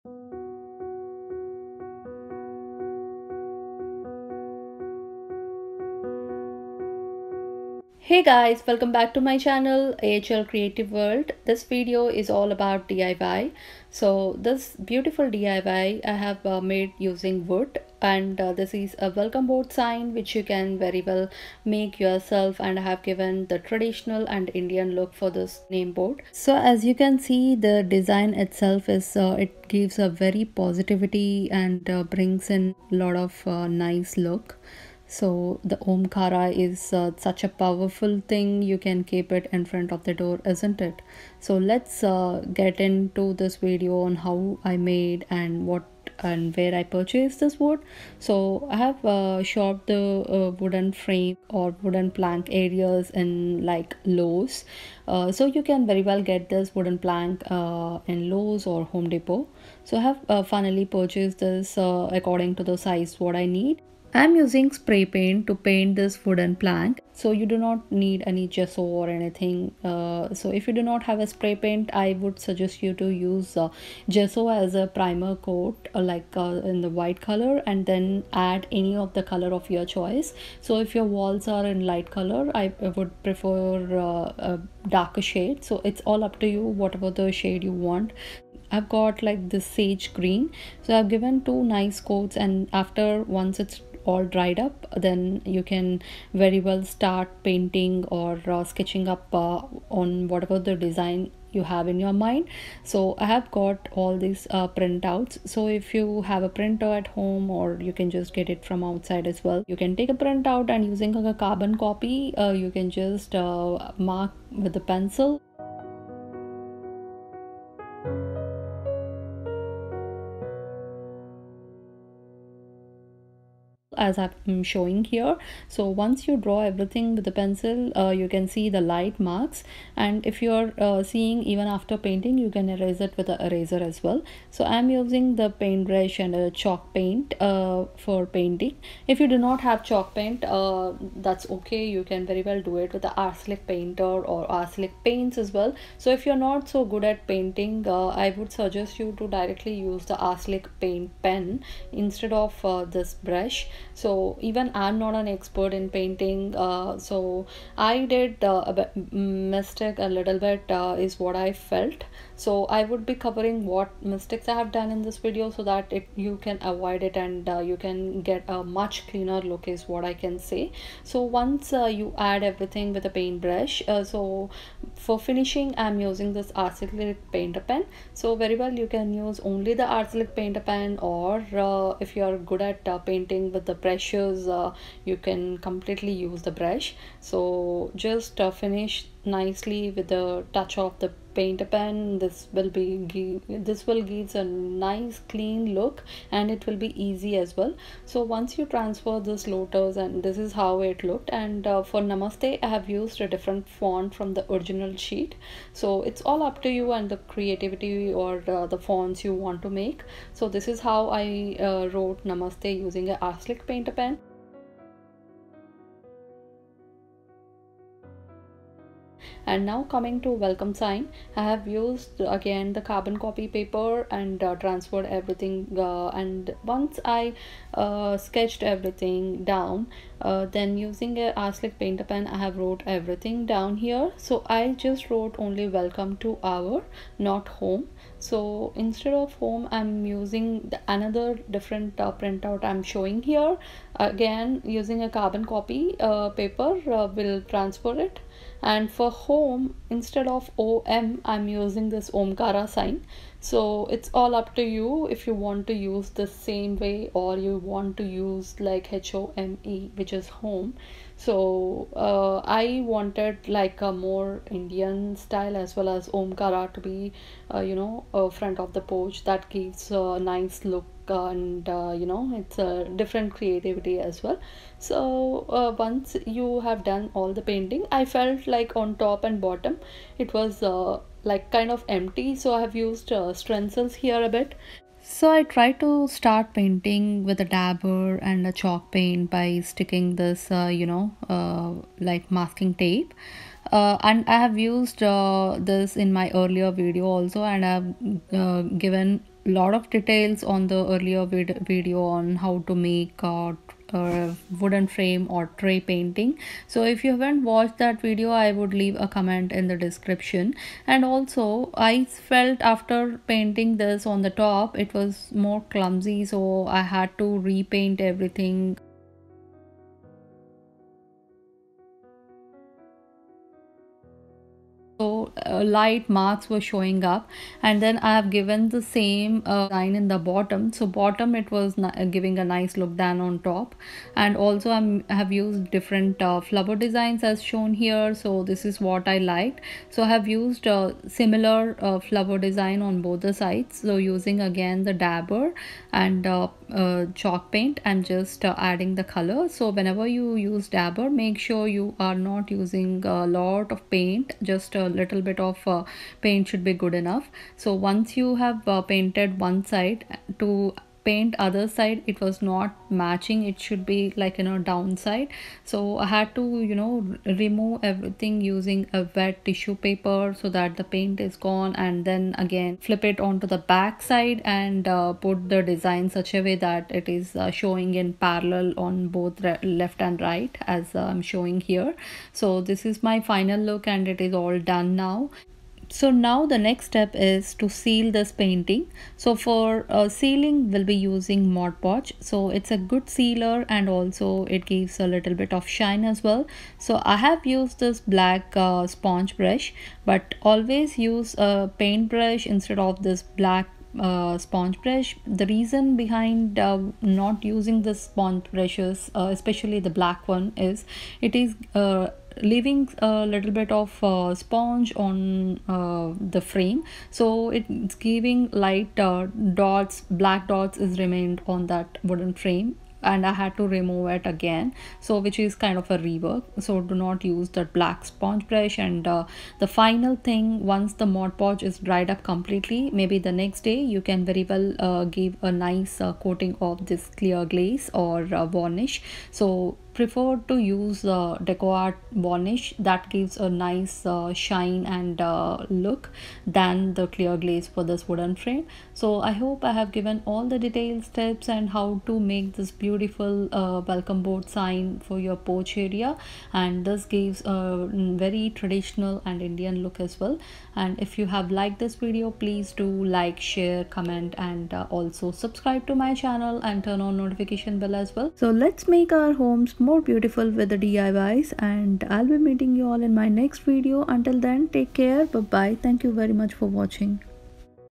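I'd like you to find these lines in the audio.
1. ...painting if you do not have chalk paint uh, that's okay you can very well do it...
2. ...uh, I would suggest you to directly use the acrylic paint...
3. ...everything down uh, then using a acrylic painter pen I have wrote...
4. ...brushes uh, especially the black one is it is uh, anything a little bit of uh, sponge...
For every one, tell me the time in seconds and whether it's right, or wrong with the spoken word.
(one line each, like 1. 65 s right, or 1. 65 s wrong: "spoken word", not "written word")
1. 138 s right
2. 147 s right
3. 228 s right
4. 408 s wrong: "leaving", not "anything".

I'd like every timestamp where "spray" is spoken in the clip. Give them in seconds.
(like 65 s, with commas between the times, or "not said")
64 s, 71 s.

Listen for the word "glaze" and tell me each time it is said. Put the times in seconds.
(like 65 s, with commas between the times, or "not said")
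437 s, 447 s.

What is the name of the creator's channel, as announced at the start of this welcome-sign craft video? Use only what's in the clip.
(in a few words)
AHL Creative World.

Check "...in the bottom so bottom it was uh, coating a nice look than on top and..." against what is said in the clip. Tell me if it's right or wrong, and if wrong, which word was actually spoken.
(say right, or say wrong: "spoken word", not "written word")
wrong: "giving", not "coating".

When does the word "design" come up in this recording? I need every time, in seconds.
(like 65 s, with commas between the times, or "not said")
27 s, 100 s, 336 s, 342 s, 375 s.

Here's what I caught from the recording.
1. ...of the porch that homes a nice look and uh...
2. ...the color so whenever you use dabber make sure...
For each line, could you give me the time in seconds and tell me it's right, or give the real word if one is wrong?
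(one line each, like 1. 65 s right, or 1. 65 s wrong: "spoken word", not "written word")
1. 268 s wrong: "gives", not "homes"
2. 348 s right.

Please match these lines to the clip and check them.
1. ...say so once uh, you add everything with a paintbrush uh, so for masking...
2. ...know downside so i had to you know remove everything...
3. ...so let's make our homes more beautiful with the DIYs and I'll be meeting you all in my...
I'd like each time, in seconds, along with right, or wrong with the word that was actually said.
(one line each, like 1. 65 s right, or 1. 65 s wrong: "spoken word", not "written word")
1. 170 s wrong: "finishing", not "masking"
2. 364 s right
3. 468 s right.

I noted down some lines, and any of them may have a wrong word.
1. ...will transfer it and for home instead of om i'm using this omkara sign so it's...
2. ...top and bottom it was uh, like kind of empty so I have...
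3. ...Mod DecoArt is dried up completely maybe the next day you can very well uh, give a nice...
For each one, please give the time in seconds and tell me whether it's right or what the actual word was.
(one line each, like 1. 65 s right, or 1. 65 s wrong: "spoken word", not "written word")
1. 247 s right
2. 278 s right
3. 431 s wrong: "Podge", not "DecoArt".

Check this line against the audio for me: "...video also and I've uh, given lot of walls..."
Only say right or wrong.
wrong.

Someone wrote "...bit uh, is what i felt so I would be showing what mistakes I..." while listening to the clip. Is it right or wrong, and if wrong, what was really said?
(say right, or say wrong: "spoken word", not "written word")
wrong: "covering", not "showing".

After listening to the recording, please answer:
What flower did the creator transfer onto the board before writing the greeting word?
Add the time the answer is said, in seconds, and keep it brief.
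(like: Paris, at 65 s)
lotus, at 199 s.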